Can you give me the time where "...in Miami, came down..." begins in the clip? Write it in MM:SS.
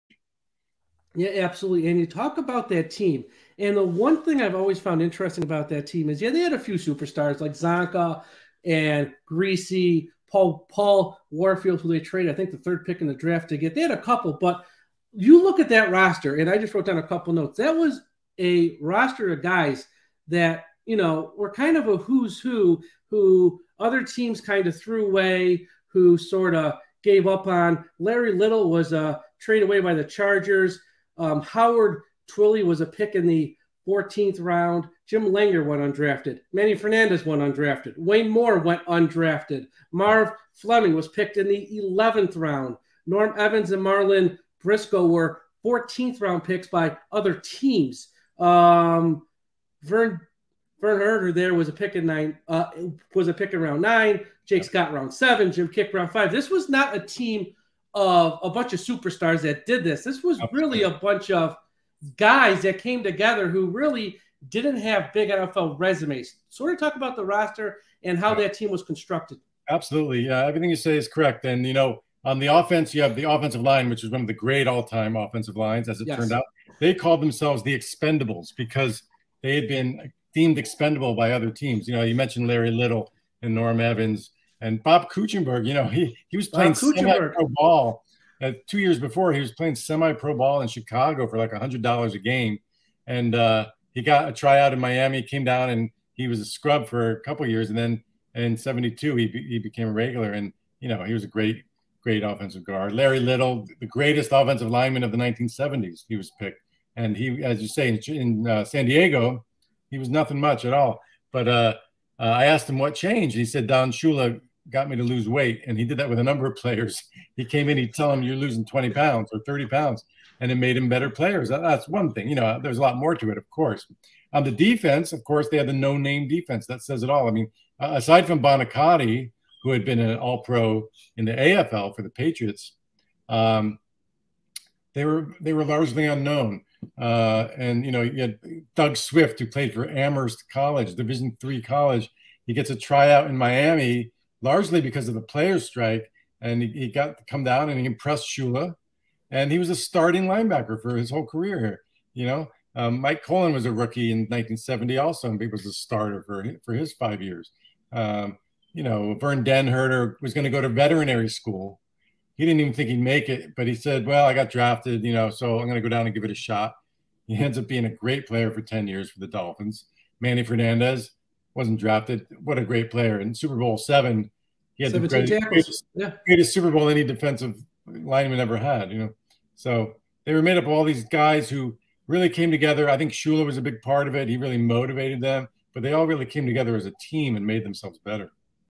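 01:34.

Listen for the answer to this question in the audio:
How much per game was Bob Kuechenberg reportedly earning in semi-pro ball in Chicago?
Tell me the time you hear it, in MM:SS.
01:31.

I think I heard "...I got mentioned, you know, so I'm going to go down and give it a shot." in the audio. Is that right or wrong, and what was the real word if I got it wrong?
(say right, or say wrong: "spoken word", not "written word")
wrong: "drafted", not "mentioned".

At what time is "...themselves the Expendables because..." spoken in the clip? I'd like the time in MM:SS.
01:17.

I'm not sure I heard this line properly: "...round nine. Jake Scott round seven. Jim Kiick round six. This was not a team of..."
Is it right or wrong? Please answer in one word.
wrong.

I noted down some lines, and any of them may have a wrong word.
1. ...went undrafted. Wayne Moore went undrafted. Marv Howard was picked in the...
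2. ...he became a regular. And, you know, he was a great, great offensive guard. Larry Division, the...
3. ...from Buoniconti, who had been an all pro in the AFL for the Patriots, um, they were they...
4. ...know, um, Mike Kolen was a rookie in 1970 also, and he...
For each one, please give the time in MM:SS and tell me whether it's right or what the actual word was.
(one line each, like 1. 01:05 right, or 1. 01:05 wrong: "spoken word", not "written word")
1. 00:37 wrong: "Fleming", not "Howard"
2. 01:39 wrong: "Little", not "Division"
3. 02:08 right
4. 02:32 right.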